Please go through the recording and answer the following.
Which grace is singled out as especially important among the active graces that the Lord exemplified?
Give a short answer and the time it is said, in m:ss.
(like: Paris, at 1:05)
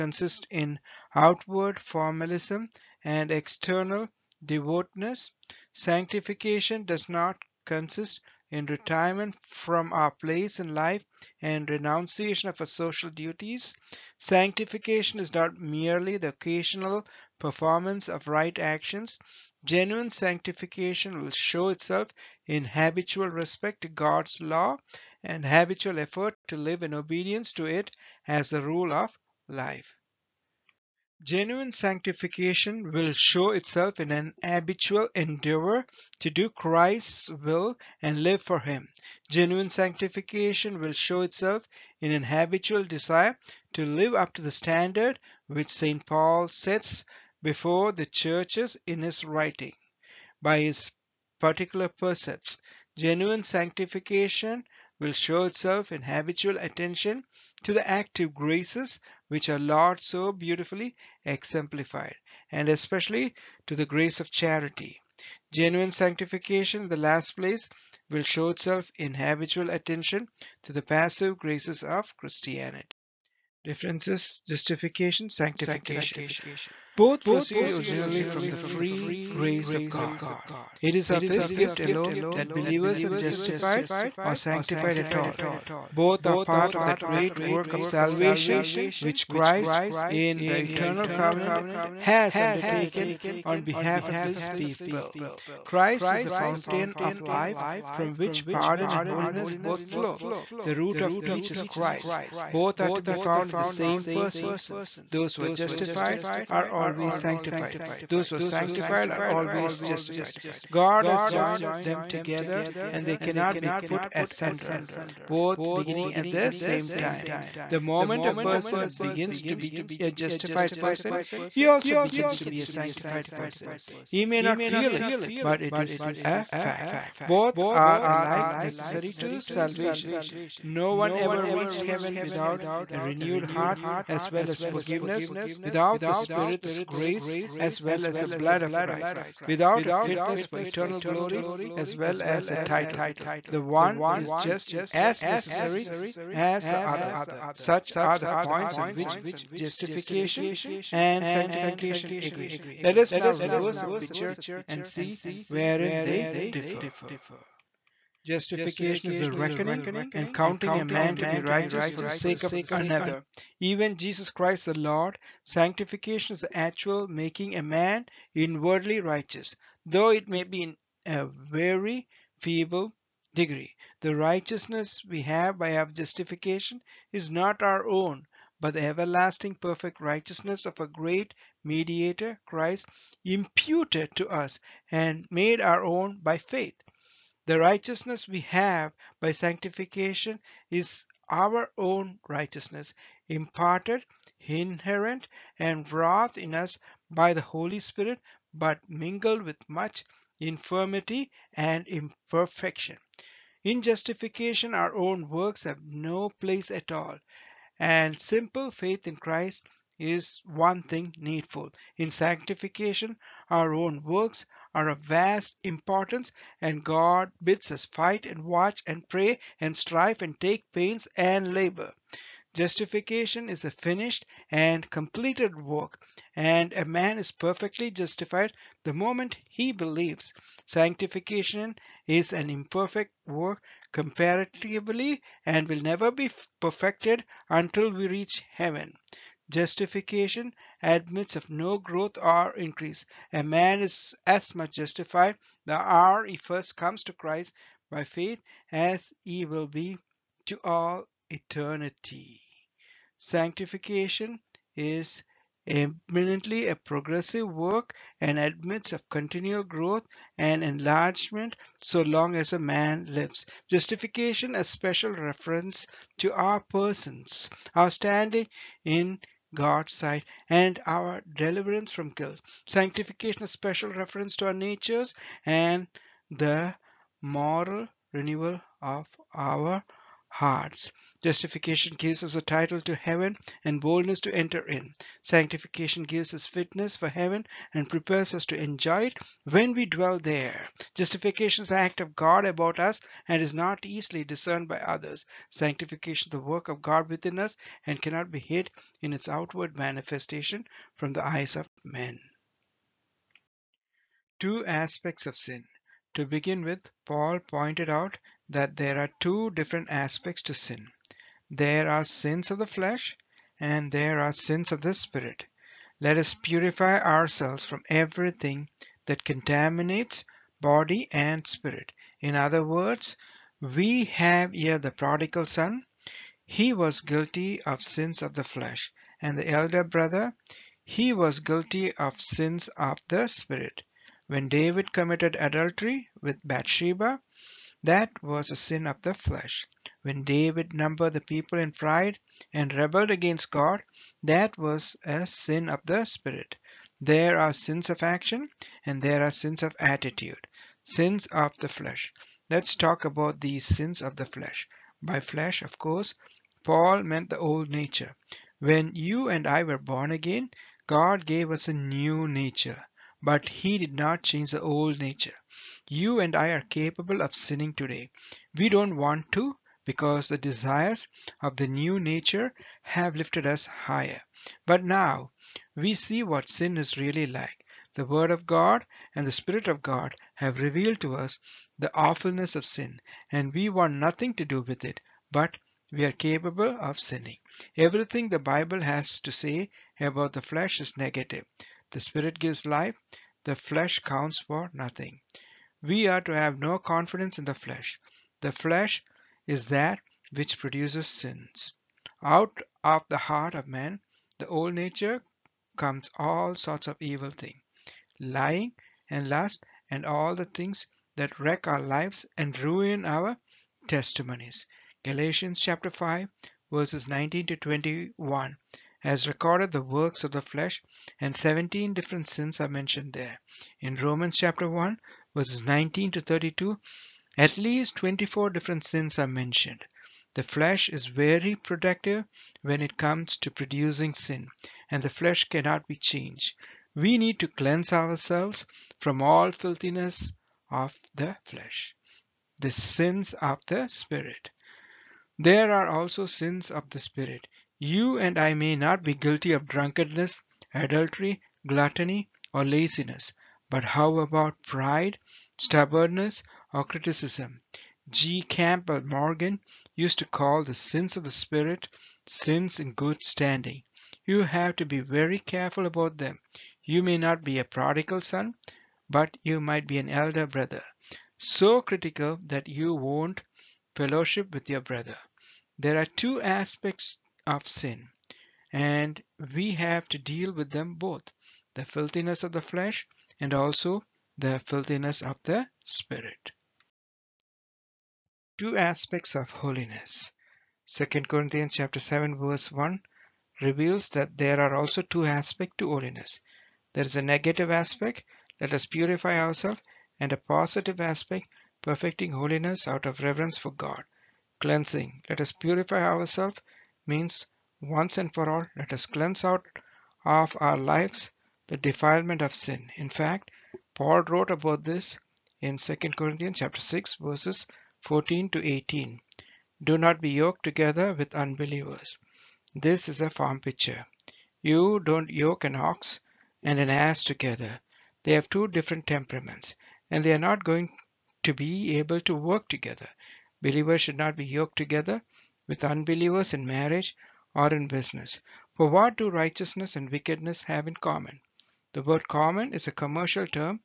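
Charity, at 1:04.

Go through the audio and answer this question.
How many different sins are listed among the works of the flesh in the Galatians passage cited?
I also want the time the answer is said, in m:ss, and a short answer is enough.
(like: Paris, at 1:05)
17, at 7:01.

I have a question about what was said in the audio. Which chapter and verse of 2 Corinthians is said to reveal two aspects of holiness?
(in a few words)
Chapter 7 verse 1.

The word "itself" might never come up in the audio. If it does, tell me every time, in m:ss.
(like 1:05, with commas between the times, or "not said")
0:21, 0:33, 0:41, 0:55, 1:08.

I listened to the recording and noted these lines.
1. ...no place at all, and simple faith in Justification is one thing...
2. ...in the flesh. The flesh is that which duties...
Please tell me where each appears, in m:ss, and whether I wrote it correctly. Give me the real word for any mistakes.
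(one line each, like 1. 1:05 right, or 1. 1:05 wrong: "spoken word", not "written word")
1. 3:25 wrong: "Christ", not "Justification"
2. 6:37 wrong: "produces", not "duties".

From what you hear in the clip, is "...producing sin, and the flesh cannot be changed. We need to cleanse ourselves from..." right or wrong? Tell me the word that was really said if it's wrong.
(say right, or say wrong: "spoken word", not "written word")
right.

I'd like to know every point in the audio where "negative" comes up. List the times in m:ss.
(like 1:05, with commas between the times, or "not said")
6:30, 8:17.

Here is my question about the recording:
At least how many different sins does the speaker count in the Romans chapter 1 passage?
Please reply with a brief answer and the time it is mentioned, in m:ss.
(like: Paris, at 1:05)
24, at 7:07.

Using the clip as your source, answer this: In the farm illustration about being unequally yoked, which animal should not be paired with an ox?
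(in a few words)
An ass.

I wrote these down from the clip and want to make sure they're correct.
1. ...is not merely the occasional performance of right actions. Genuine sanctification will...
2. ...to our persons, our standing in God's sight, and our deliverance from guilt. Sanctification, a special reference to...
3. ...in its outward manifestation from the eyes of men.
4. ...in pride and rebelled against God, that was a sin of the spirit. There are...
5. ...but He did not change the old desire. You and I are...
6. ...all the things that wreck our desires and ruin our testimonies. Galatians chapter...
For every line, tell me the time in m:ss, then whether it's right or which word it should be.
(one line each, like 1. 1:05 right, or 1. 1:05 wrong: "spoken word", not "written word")
1. 0:15 right
2. 4:26 right
3. 4:59 right
4. 5:41 right
5. 6:03 wrong: "nature", not "desire"
6. 6:50 wrong: "lives", not "desires".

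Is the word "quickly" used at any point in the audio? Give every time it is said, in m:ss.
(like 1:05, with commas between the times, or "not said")
not said.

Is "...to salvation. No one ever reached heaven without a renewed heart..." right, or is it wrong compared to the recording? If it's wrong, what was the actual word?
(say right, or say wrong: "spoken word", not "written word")
right.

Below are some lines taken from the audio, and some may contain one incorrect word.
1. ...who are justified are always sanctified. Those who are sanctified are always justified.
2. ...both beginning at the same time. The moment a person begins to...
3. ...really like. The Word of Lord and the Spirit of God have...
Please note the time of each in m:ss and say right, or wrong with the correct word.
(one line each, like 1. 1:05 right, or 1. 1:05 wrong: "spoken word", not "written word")
1. 1:45 right
2. 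1:55 right
3. 6:16 wrong: "God", not "Lord".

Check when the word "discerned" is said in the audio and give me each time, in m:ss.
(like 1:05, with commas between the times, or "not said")
4:54.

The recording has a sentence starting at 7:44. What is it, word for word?
You have to be very careful about them.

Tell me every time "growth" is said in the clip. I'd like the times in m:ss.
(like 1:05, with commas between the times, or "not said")
4:01, 4:19.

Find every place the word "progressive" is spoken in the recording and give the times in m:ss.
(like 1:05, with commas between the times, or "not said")
4:16.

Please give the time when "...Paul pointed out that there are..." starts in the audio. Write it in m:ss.
5:07.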